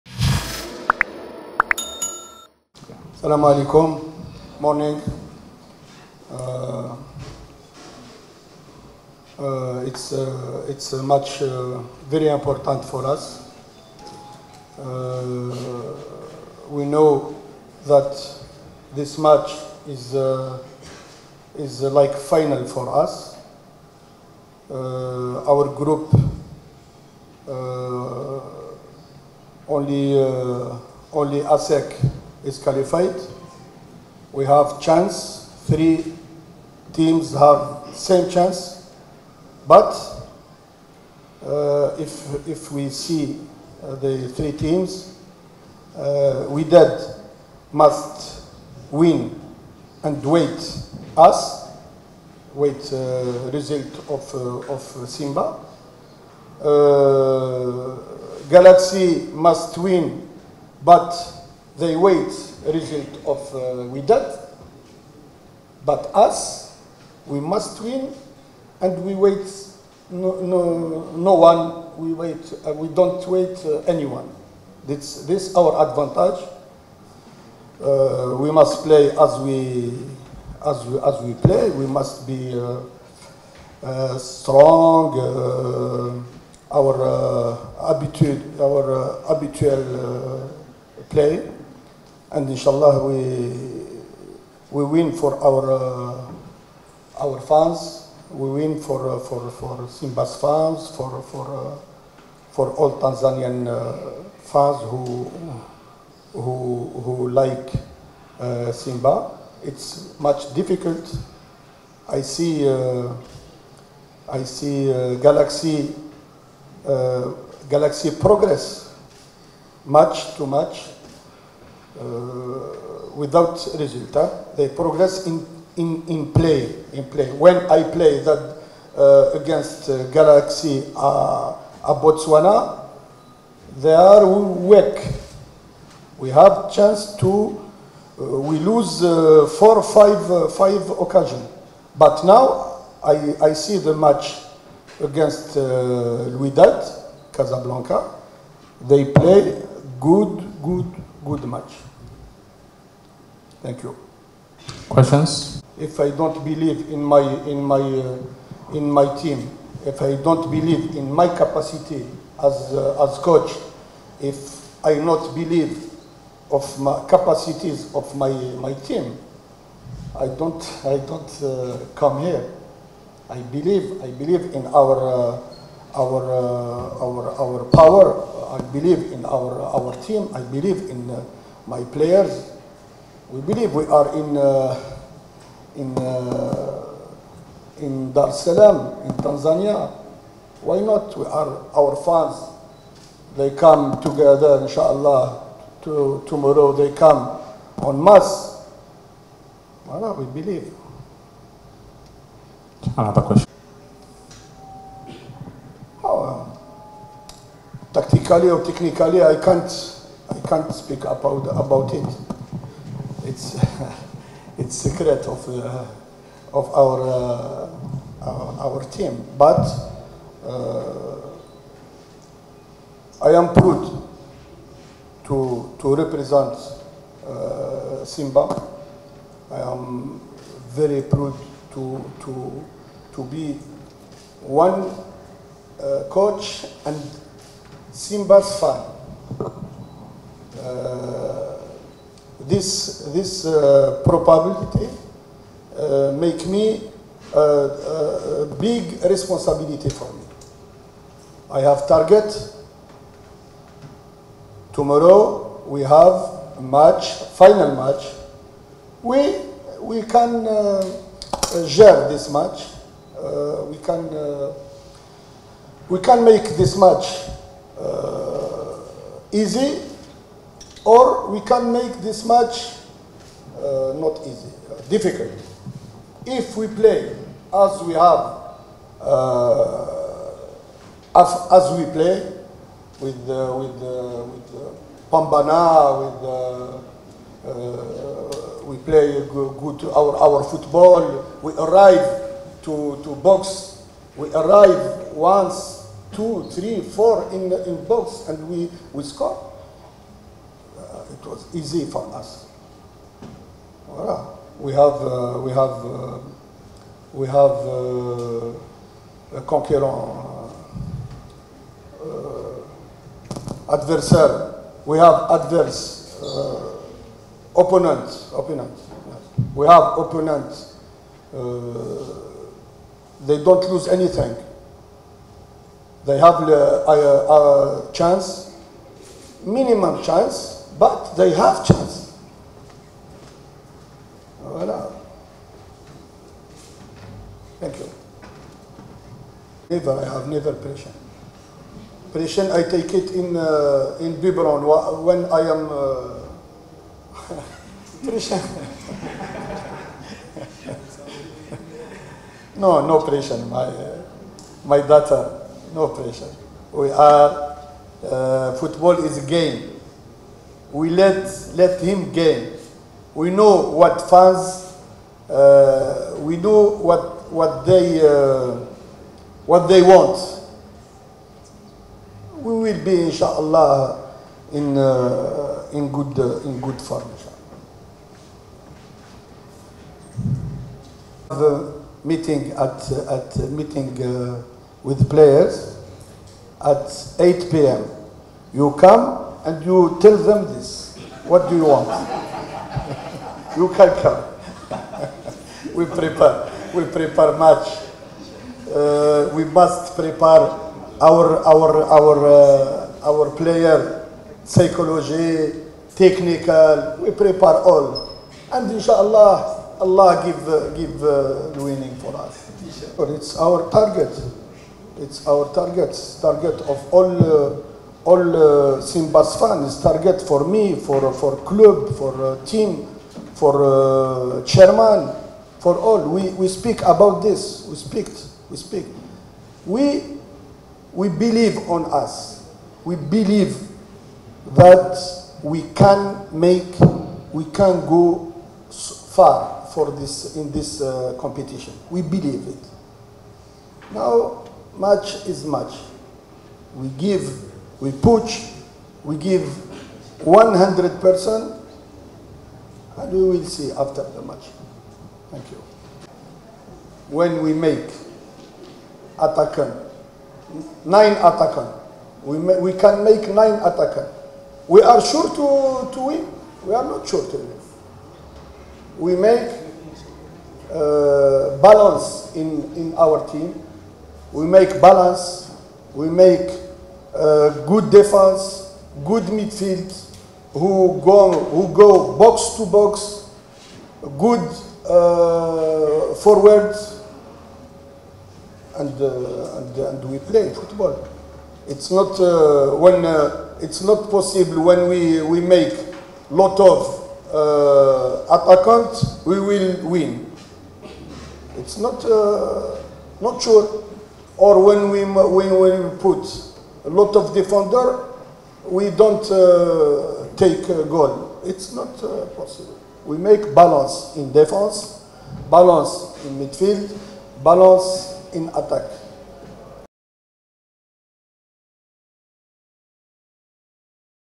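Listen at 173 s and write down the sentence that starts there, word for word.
I believe I believe in our uh, our uh, our our power I believe in our, our team.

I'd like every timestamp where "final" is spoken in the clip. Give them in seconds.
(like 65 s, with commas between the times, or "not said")
22 s, 257 s.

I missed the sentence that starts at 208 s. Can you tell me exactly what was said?
politically or technically, I can't, I can't speak about, about it.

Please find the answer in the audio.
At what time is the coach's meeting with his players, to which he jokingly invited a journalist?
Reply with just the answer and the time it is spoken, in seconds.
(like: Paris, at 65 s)
8 p.m., at 387 s.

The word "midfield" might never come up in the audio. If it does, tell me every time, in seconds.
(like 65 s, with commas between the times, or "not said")
479 s, 516 s.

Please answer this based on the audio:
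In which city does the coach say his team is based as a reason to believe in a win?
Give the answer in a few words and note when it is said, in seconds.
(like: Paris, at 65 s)
Dar es Salaam, at 188 s.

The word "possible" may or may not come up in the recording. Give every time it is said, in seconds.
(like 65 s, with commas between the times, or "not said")
494 s, 512 s.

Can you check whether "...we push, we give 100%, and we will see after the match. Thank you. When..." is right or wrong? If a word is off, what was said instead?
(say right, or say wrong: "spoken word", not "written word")
right.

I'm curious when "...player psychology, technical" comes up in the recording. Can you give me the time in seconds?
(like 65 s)
403 s.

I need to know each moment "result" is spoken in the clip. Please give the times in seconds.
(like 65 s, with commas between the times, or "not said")
53 s, 62 s, 123 s.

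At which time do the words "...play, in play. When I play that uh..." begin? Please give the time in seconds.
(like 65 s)
126 s.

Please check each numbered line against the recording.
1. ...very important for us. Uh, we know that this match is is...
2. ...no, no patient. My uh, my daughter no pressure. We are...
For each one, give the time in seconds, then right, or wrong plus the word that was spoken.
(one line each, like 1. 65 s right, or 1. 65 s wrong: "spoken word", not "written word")
1. 12 s right
2. 352 s right.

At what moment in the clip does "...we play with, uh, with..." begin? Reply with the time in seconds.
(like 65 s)
281 s.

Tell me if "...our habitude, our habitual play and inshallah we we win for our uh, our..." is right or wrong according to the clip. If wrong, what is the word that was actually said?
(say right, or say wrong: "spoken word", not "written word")
right.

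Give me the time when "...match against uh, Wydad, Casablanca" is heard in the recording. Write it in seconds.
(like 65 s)
143 s.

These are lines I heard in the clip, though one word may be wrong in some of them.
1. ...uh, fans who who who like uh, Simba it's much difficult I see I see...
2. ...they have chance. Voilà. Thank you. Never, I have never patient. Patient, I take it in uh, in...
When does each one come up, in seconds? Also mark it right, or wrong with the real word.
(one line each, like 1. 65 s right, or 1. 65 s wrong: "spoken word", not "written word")
1. 103 s right
2. 331 s right.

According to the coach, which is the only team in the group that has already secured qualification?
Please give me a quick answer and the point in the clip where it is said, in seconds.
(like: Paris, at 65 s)
ASEC, at 31 s.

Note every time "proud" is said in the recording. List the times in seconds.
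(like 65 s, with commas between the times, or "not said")
223 s, 231 s.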